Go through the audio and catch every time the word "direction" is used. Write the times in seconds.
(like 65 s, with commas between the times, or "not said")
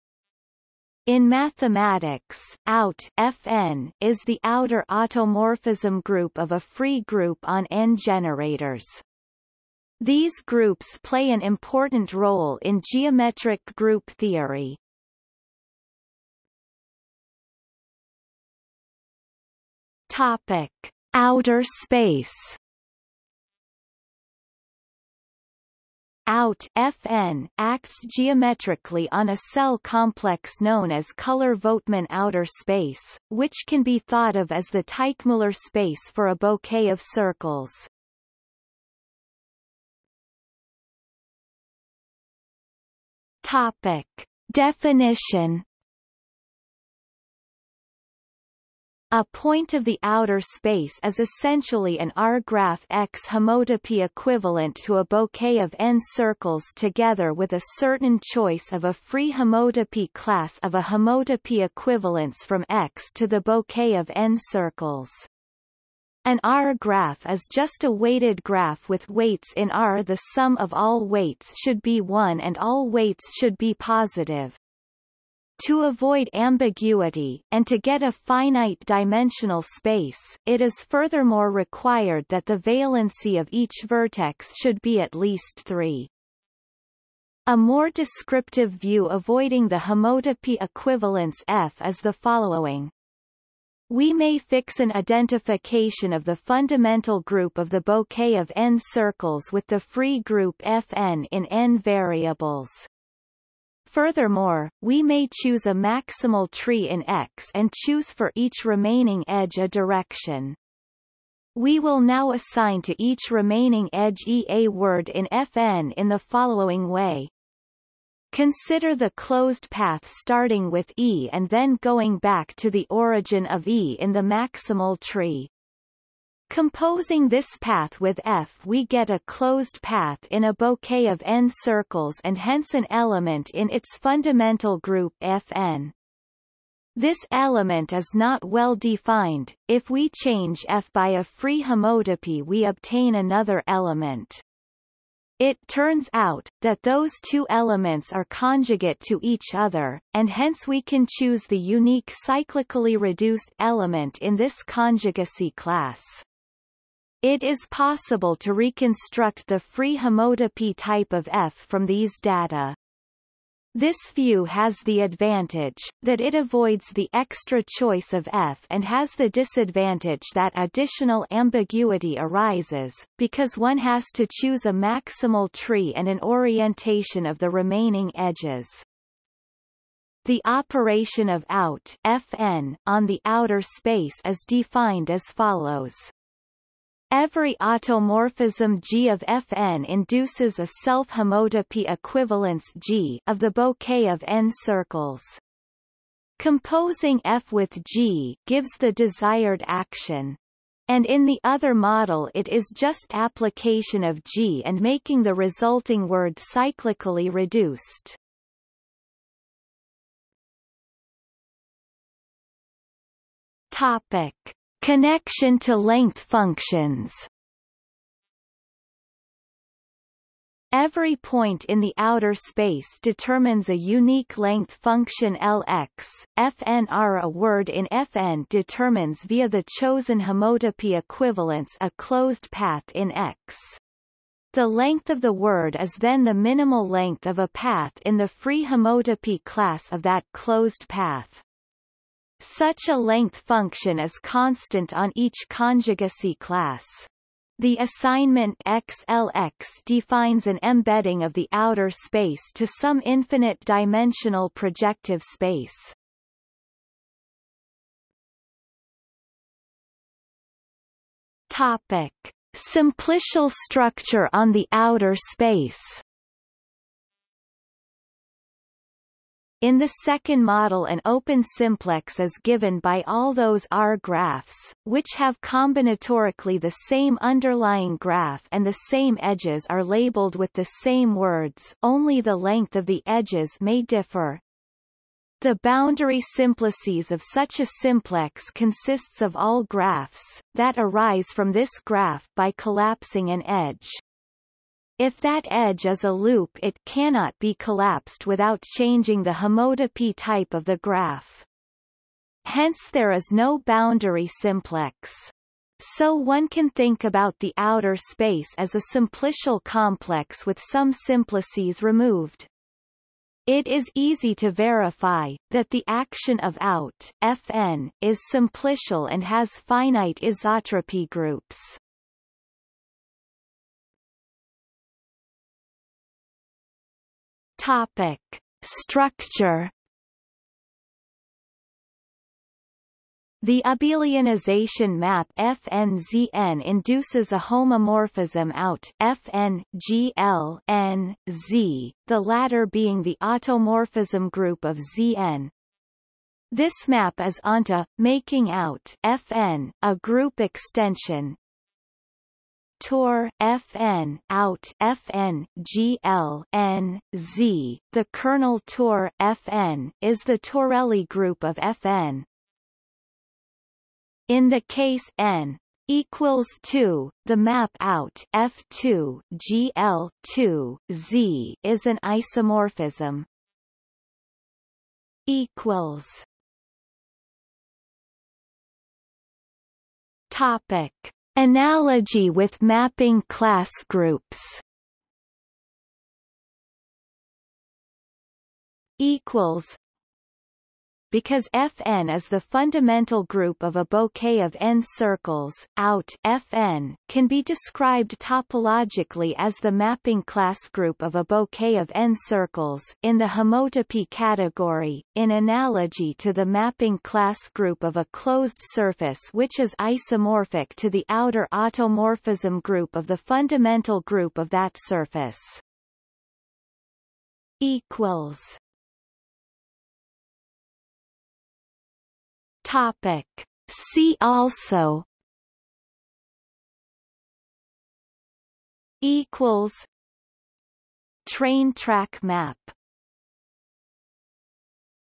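109 s.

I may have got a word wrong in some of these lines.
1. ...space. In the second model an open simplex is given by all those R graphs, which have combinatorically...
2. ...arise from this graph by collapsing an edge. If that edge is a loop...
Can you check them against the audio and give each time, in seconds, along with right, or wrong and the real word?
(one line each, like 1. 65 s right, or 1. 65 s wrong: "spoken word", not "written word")
1. 265 s right
2. 290 s right.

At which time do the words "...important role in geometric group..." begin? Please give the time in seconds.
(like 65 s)
11 s.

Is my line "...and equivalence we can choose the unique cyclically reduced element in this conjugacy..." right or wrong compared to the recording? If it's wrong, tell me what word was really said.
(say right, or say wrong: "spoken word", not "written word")
wrong: "hence", not "equivalence".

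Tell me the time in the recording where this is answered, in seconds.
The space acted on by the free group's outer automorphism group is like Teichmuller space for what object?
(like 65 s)
36 s.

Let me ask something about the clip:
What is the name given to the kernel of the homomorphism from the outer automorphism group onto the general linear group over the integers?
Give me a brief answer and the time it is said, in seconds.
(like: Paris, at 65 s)
Torelli group, at 360 s.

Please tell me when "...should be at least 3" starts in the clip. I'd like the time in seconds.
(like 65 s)
84 s.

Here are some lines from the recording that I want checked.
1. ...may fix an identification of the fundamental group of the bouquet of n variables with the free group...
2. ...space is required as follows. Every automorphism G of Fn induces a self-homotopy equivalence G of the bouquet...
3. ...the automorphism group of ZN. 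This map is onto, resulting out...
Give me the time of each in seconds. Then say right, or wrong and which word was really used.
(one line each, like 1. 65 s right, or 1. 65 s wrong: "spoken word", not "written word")
1. 94 s wrong: "circles", not "variables"
2. 183 s wrong: "defined", not "required"
3. 343 s wrong: "making", not "resulting".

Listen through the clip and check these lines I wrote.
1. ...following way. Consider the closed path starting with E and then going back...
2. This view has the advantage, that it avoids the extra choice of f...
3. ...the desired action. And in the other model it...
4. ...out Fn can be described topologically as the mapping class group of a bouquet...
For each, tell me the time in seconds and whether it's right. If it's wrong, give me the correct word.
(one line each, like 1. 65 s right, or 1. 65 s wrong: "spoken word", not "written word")
1. 116 s right
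2. 163 s right
3. 198 s right
4. 395 s right.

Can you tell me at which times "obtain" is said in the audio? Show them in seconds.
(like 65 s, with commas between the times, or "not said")
142 s.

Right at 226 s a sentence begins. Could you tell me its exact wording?
Fnr A word in Fn determines via the chosen homotopy equivalence a closed path in X.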